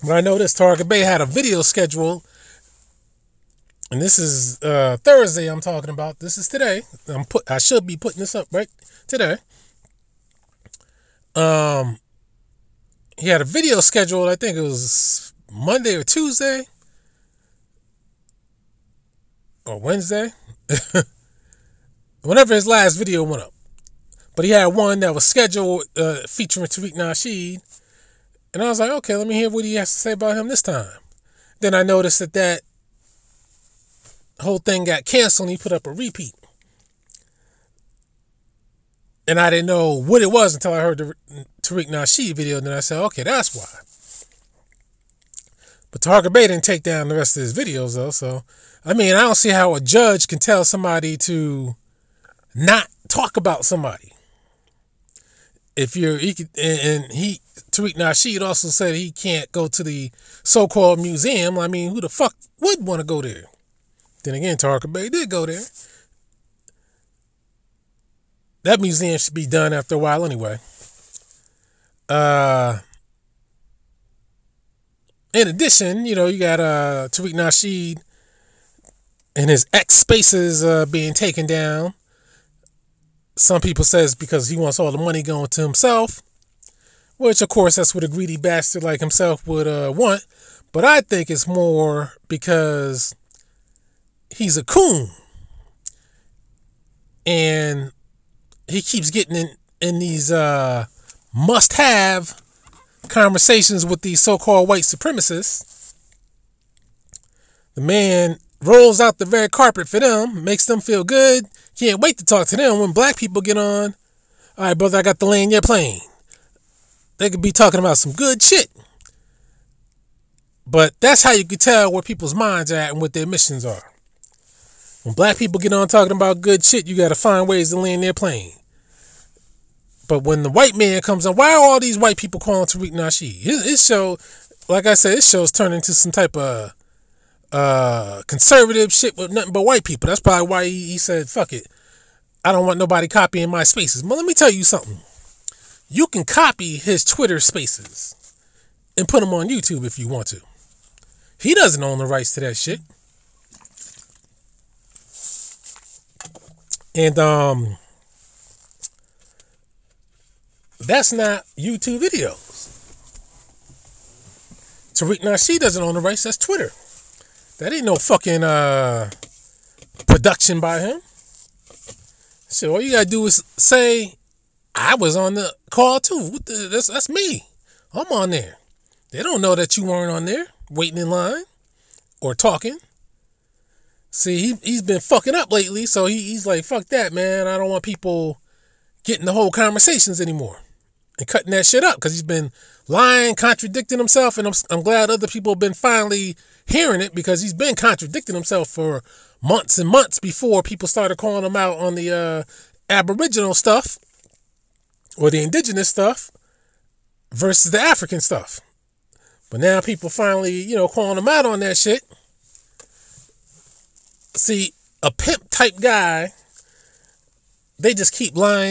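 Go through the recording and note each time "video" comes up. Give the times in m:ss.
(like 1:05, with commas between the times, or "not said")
0:01, 0:13, 0:22, 0:42, 0:47, 2:41.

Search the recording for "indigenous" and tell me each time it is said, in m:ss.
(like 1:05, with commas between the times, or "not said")
3:25.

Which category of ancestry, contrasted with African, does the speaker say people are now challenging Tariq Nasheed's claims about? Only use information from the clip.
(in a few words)
Aboriginal.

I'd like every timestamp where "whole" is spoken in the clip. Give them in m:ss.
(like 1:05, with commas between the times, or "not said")
0:34, 3:09.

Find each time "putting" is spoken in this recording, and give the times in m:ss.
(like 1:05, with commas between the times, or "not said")
0:07.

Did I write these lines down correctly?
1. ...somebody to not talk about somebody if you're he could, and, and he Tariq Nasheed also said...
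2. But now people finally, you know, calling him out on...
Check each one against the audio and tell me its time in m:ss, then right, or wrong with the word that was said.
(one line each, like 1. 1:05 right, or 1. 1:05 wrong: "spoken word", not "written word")
1. 0:50 right
2. 3:29 right.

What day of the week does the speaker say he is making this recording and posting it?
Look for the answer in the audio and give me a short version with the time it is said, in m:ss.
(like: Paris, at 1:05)
Thursday, at 0:05.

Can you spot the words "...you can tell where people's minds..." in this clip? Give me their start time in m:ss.
2:01.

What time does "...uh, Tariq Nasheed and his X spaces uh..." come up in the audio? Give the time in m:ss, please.
1:16.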